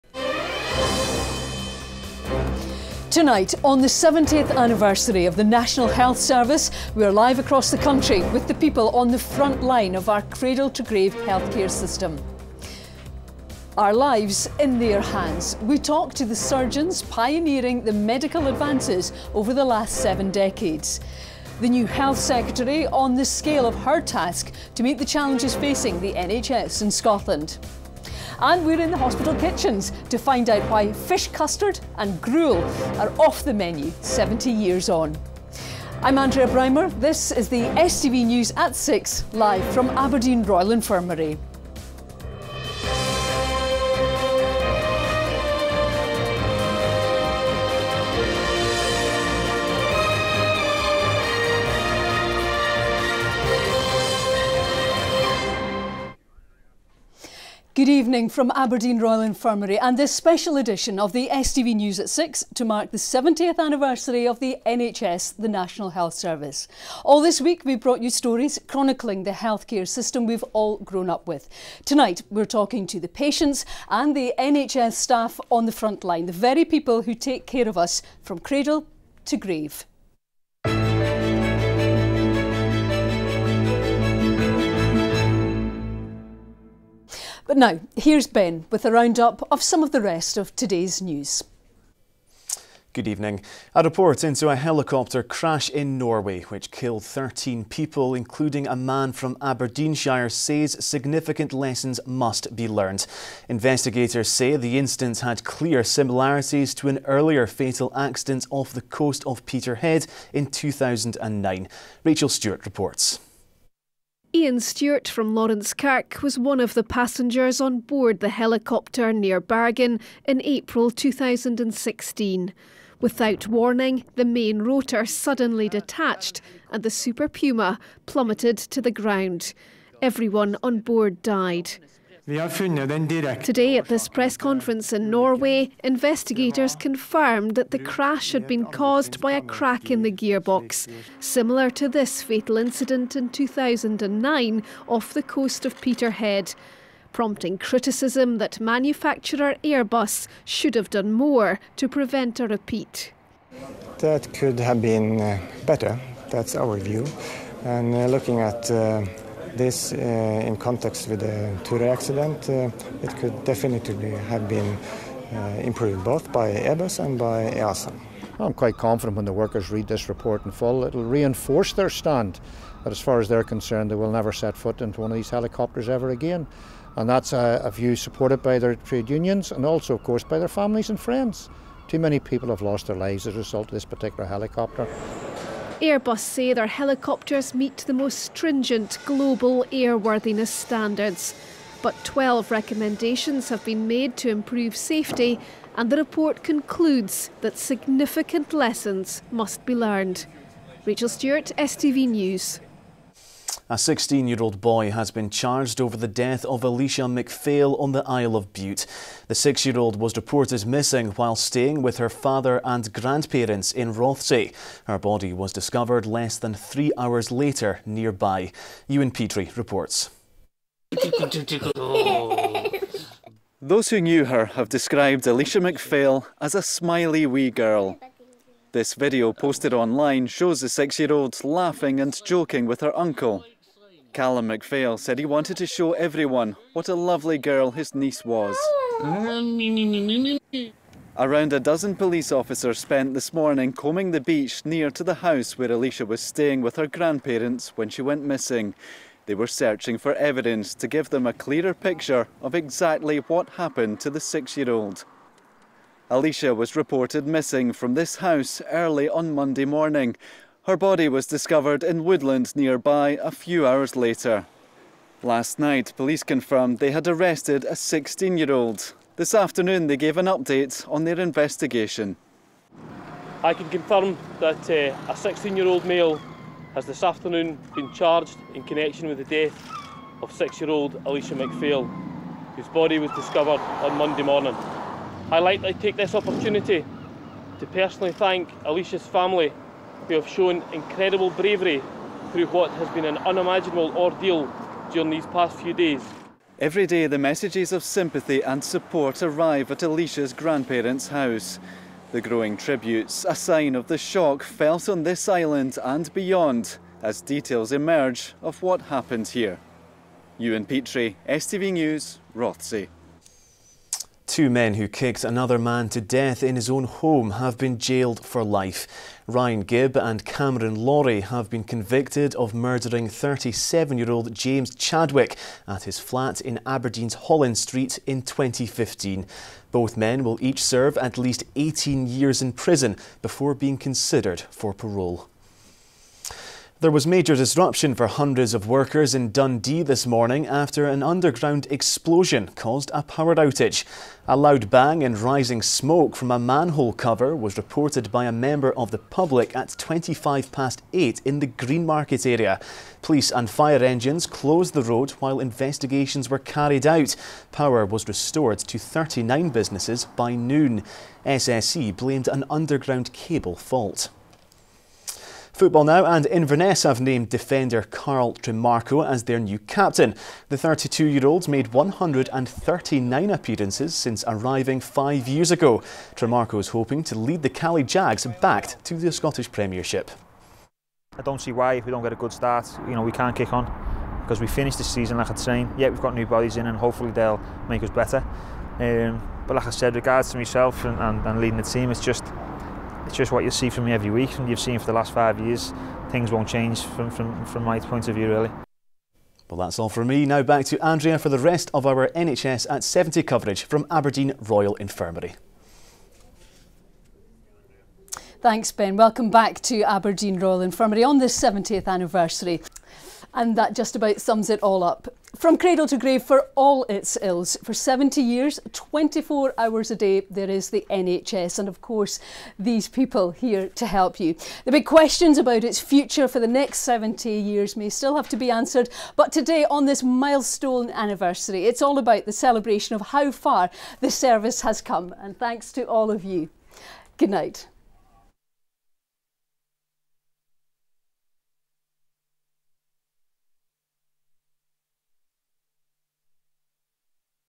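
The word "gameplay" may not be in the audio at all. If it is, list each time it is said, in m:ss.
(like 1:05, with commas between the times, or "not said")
not said.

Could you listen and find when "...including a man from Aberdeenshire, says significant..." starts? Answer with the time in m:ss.
1:38.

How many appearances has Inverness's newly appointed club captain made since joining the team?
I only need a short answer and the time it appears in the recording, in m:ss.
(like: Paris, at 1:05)
139, at 6:11.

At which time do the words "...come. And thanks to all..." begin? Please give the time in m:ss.
7:14.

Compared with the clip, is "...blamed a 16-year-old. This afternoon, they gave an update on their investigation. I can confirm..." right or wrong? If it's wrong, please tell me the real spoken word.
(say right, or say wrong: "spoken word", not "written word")
wrong: "arrested", not "blamed".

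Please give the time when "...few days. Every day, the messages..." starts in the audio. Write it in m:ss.
4:55.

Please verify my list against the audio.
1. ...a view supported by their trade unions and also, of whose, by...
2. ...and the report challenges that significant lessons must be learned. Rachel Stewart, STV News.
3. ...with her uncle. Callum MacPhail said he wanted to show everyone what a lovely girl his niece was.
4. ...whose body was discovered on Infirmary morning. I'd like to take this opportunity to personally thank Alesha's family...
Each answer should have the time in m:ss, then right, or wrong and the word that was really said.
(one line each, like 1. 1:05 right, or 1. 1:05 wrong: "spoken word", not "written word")
1. 2:57 wrong: "course", not "whose"
2. 3:15 wrong: "concludes", not "challenges"
3. 3:52 right
4. 4:42 wrong: "Monday", not "Infirmary".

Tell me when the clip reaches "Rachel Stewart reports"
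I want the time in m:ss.
1:52.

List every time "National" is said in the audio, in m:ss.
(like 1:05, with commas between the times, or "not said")
0:05, 1:05.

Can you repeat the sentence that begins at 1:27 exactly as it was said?
But now, here's Ben with a roundup of some of the rest of today's news.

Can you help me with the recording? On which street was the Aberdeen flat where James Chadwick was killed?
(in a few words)
Holland Street.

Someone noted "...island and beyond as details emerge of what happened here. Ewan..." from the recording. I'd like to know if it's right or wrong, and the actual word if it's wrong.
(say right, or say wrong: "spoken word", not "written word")
right.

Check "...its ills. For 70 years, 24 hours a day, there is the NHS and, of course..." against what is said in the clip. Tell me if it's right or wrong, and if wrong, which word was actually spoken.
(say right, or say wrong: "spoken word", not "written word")
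right.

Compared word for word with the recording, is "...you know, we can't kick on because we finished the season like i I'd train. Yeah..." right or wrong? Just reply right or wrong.
right.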